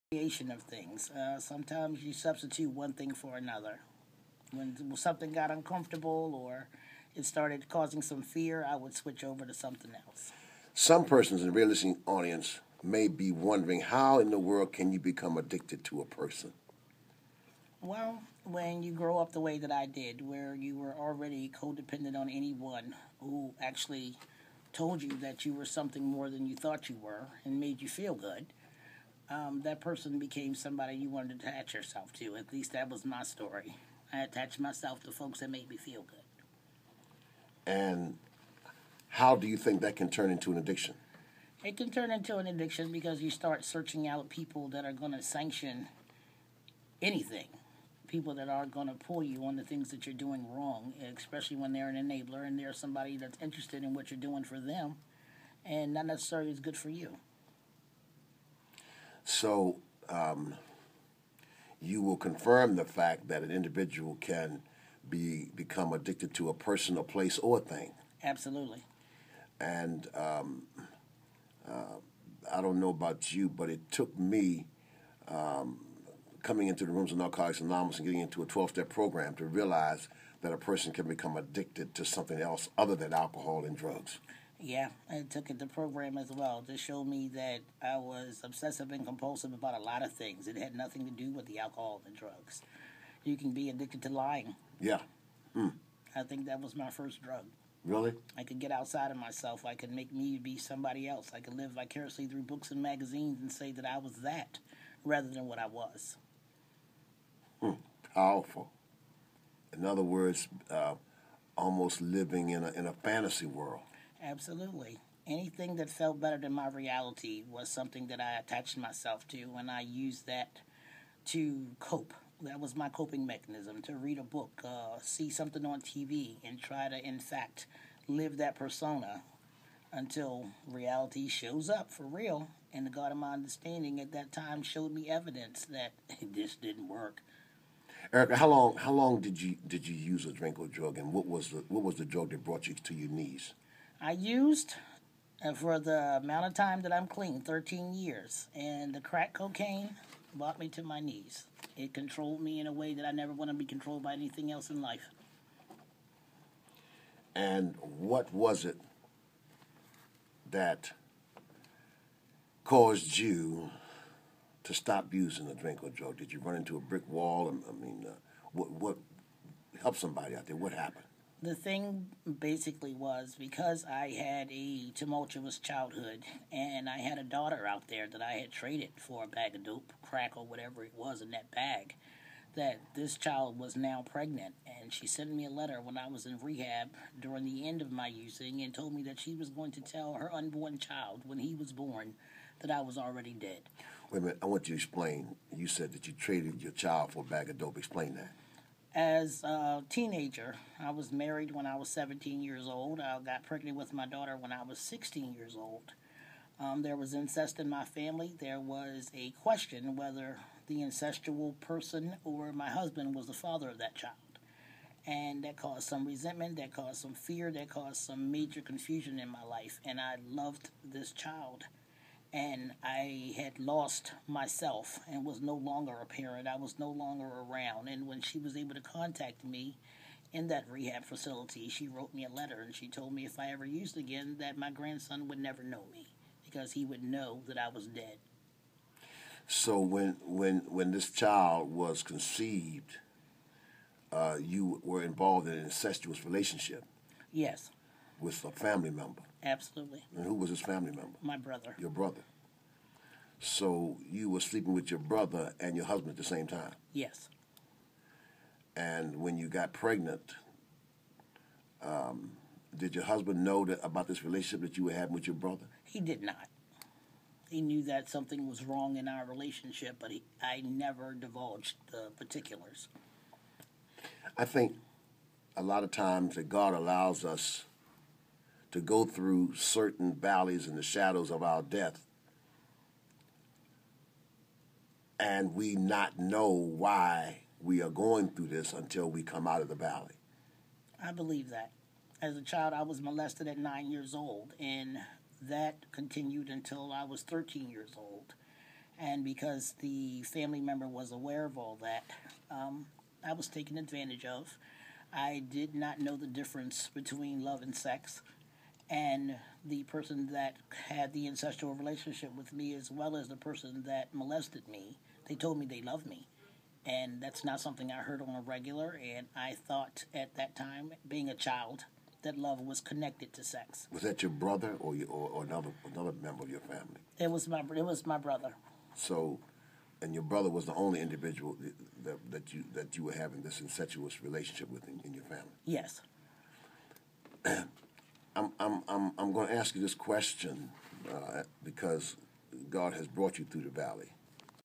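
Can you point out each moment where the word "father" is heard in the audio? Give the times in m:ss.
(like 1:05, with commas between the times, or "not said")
3:33.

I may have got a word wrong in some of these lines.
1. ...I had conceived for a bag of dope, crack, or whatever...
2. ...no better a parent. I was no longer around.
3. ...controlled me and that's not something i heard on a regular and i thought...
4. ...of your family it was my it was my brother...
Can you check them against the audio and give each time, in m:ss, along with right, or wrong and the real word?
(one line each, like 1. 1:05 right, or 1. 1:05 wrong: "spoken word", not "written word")
1. 2:58 wrong: "traded", not "conceived"
2. 3:45 wrong: "longer", not "better"
3. 5:15 wrong: "loved", not "controlled"
4. 5:26 right.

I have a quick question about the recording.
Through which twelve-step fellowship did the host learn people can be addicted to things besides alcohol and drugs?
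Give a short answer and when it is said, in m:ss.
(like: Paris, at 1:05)
Narcotics Anonymous, at 1:17.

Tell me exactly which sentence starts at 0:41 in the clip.
It can turn into an addiction because you start searching out people that are going to sanction anything.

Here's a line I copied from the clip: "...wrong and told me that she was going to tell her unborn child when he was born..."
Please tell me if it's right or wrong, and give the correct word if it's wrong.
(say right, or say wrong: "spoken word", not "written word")
wrong: "using", not "wrong".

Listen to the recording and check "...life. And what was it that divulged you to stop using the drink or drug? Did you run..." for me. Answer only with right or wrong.
wrong.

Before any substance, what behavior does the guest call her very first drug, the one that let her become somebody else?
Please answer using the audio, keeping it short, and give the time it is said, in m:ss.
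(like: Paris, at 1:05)
Lying, at 1:34.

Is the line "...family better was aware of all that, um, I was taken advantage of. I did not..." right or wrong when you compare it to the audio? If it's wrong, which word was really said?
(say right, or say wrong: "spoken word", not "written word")
wrong: "member", not "better".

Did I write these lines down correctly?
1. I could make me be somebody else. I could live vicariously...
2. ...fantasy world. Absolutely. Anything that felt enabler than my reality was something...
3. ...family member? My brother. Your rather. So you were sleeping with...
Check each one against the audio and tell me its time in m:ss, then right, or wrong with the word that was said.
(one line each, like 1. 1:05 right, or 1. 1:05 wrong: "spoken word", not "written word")
1. 1:39 right
2. 1:52 wrong: "better", not "enabler"
3. 4:10 wrong: "brother", not "rather".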